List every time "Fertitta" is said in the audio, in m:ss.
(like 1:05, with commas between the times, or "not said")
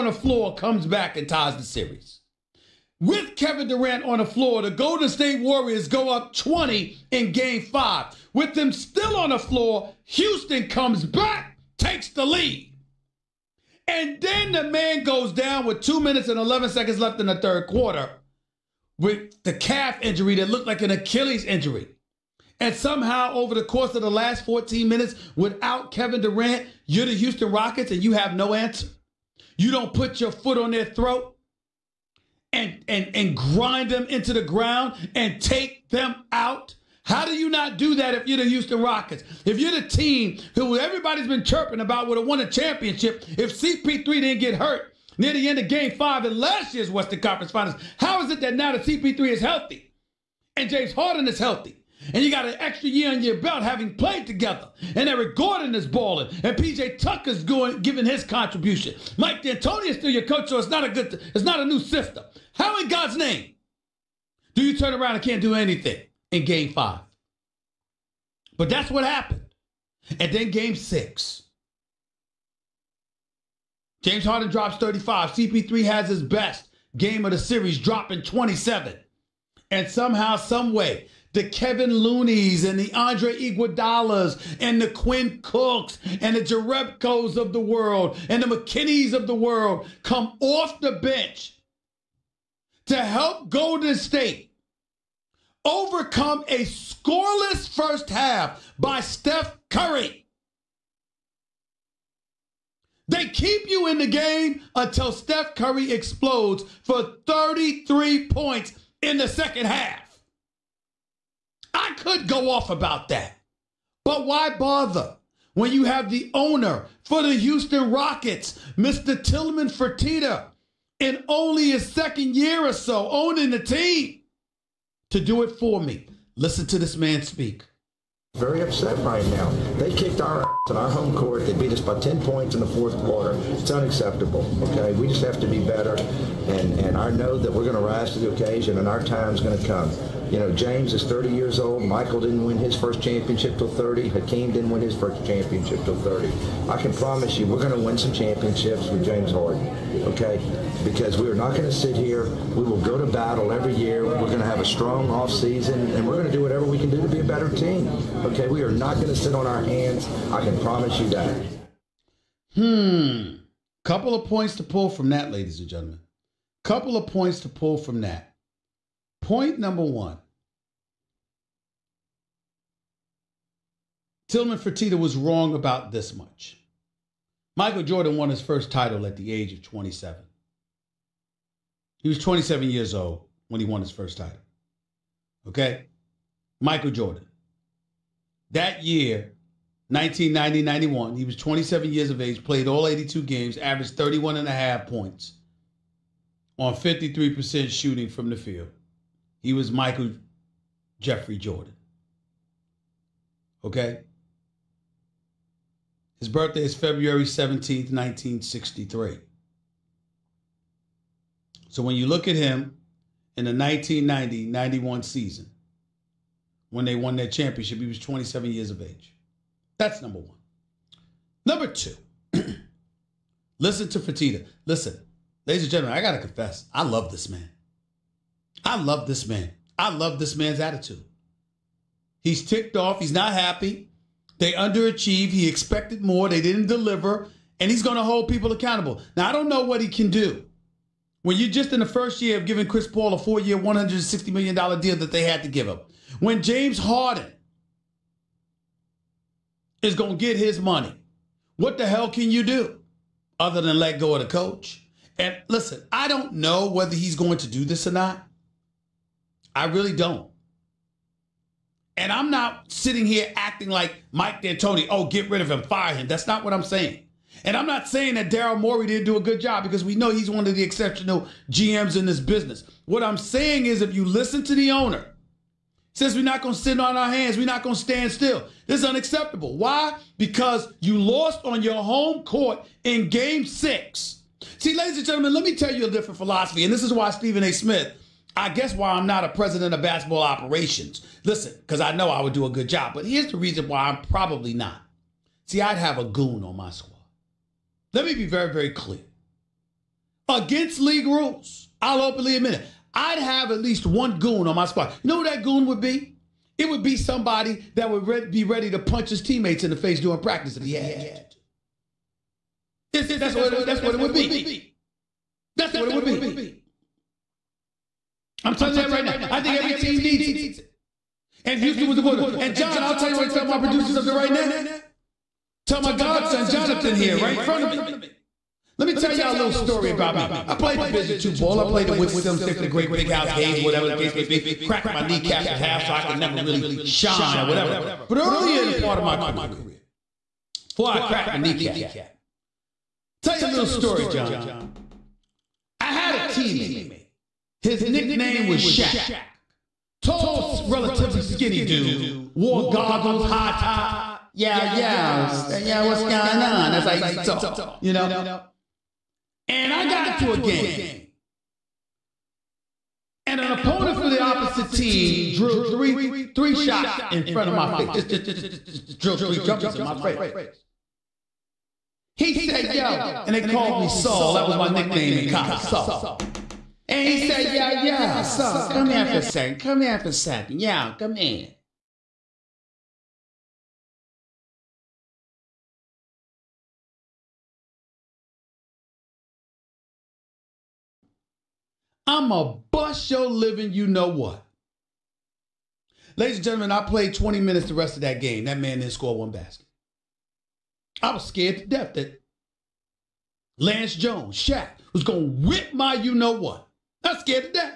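1:59, 2:54.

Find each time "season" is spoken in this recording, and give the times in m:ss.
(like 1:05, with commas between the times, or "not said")
2:35, 3:35.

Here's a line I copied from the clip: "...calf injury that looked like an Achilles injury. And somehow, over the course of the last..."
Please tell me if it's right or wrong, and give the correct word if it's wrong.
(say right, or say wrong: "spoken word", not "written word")
right.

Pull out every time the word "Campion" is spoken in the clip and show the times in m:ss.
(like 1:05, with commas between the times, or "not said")
not said.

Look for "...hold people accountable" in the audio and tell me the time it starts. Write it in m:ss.
3:58.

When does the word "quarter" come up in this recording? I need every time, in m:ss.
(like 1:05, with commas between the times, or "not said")
0:17, 2:13.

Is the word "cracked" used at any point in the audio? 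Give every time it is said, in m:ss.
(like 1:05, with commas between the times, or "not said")
5:34, 5:41.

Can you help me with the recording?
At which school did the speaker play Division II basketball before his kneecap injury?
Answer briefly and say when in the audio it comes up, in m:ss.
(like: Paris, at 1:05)
Winston State, at 5:31.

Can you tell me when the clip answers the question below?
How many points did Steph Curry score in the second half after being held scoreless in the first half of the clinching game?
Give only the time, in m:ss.
1:47.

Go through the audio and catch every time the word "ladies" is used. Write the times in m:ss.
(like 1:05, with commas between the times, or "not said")
2:45, 3:45, 4:44, 6:36.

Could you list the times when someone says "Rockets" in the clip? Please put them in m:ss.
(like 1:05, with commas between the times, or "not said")
0:27, 0:38, 1:57.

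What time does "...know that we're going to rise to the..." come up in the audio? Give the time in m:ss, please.
2:17.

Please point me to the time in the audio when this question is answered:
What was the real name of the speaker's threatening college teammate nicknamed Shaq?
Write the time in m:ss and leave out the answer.
6:43.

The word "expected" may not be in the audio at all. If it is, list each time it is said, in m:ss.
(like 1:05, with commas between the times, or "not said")
3:55.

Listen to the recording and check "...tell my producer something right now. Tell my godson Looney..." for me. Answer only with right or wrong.
wrong.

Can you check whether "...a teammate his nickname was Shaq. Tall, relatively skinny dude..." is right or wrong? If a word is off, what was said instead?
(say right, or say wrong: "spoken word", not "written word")
right.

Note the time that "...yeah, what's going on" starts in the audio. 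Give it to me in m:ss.
5:55.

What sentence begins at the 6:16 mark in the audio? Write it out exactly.
And he said, yo, yo, so come here for a second.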